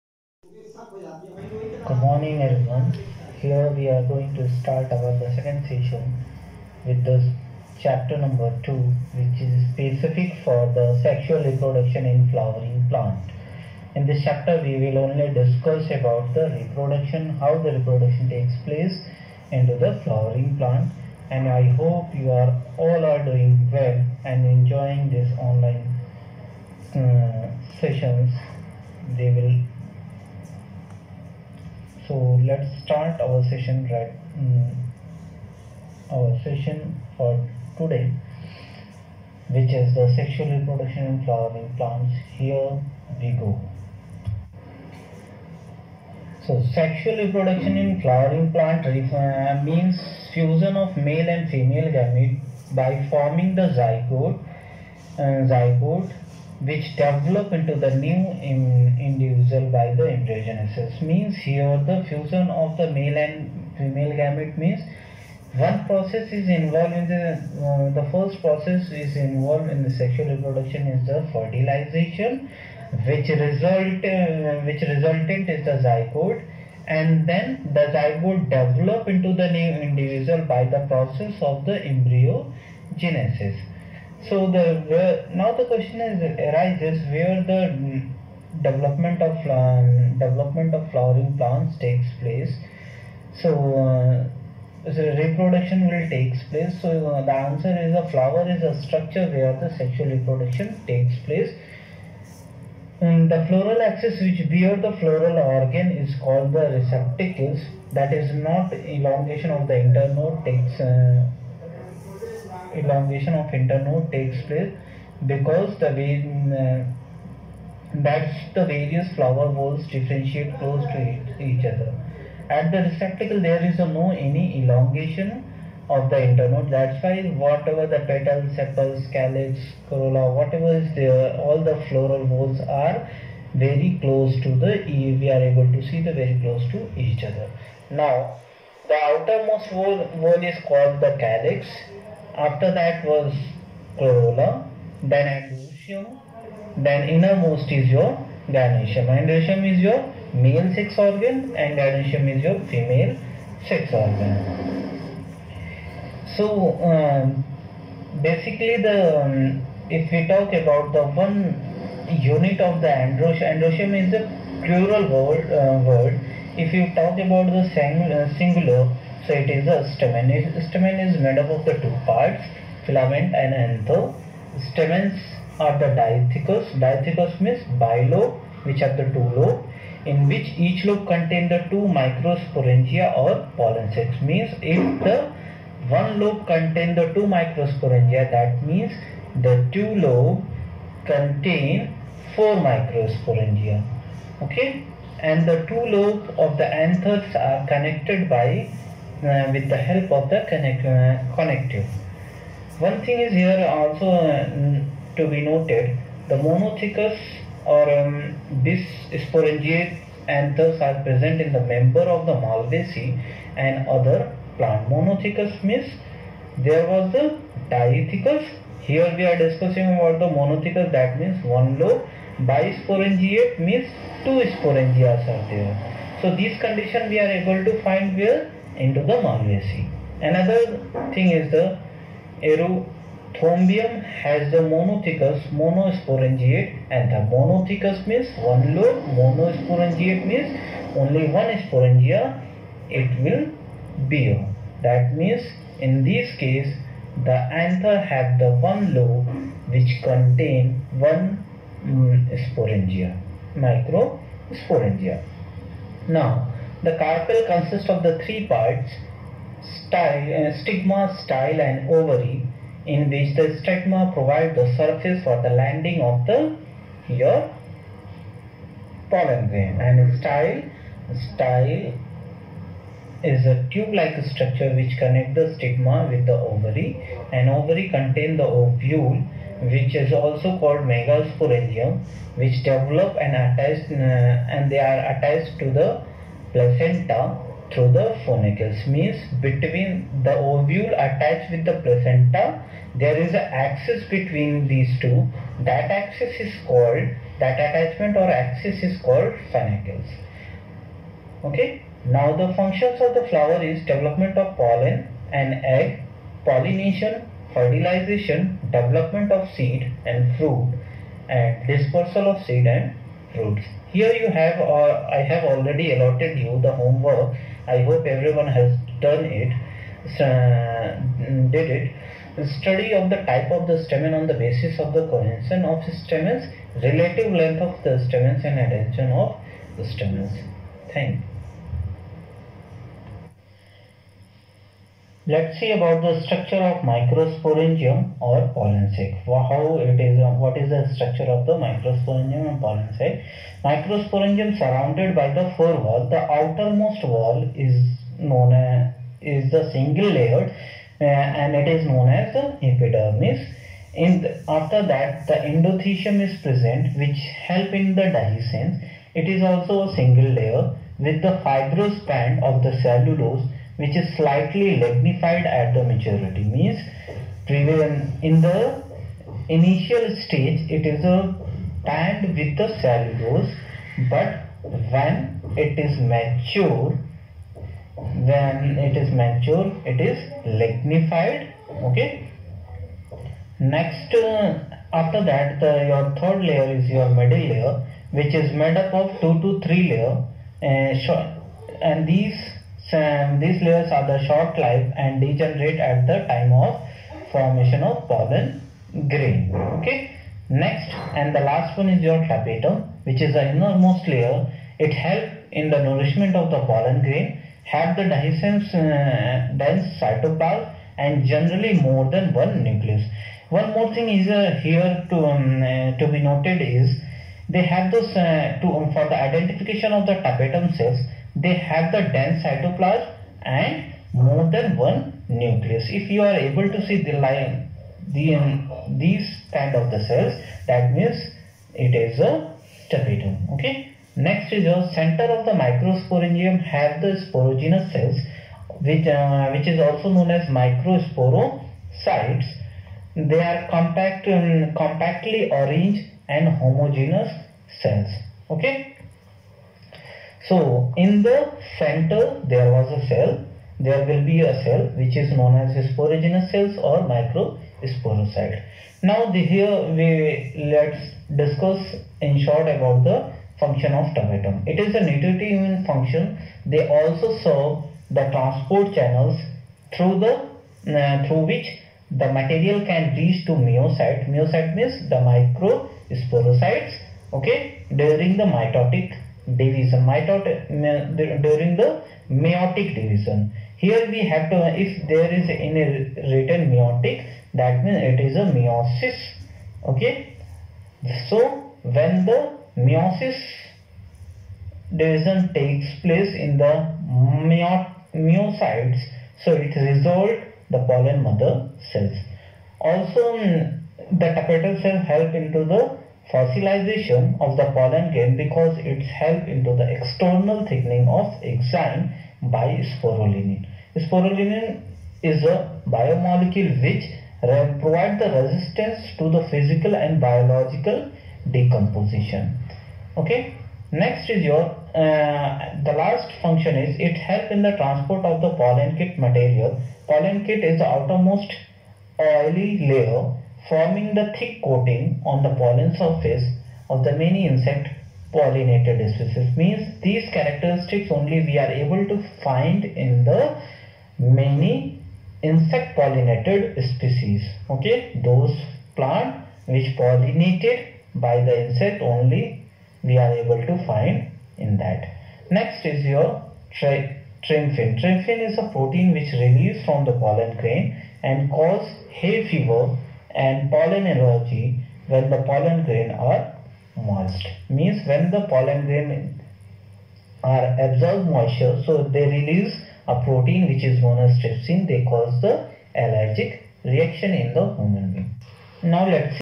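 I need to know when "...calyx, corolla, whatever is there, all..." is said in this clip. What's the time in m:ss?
2:09.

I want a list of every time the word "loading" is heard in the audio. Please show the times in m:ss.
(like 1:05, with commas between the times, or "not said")
not said.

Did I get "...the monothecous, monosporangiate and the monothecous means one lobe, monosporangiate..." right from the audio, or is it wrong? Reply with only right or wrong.
right.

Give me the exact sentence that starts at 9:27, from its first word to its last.
Means when the pollen grain are absorb moisture, so they release a protein which is known as trypsin.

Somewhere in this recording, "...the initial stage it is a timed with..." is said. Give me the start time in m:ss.
6:08.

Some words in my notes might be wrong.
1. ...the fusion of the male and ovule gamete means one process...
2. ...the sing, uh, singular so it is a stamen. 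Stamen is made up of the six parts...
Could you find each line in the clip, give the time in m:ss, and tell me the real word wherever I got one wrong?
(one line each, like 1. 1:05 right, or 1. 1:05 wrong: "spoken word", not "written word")
1. 1:01 wrong: "female", not "ovule"
2. 2:47 wrong: "two", not "six".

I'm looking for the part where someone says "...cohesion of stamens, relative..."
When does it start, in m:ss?
5:25.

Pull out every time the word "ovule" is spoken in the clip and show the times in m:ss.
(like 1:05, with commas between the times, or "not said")
4:38, 4:50.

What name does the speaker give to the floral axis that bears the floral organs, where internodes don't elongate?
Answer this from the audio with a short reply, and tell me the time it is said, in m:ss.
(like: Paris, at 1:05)
Receptacle, at 1:46.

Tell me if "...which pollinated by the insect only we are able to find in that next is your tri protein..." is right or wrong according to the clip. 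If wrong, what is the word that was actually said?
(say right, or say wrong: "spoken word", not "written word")
wrong: "trypsin", not "protein".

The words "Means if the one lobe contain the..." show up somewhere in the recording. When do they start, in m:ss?
3:04.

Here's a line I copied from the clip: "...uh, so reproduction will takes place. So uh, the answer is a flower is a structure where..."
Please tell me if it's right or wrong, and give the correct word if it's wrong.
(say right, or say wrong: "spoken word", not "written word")
right.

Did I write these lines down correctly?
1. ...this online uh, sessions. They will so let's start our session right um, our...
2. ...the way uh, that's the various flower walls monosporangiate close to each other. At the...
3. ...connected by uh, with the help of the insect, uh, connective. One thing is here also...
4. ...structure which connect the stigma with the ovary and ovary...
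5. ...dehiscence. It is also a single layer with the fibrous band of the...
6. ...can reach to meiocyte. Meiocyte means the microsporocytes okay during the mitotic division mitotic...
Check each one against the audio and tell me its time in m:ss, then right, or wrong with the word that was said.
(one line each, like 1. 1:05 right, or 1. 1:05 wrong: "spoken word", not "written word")
1. 0:25 right
2. 1:55 wrong: "differentiate", not "monosporangiate"
3. 3:17 wrong: "connect", not "insect"
4. 4:34 right
5. 5:58 right
6. 7:52 right.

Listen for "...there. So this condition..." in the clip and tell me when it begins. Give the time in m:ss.
3:45.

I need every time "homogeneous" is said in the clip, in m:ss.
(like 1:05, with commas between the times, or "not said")
7:26.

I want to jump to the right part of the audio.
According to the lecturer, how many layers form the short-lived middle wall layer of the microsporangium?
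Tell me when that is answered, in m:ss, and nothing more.
6:29.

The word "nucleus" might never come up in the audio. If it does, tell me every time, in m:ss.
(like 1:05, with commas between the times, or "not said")
6:52, 7:05.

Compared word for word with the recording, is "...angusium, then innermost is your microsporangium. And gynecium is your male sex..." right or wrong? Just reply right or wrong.
wrong.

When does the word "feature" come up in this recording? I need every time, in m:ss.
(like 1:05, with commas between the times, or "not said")
not said.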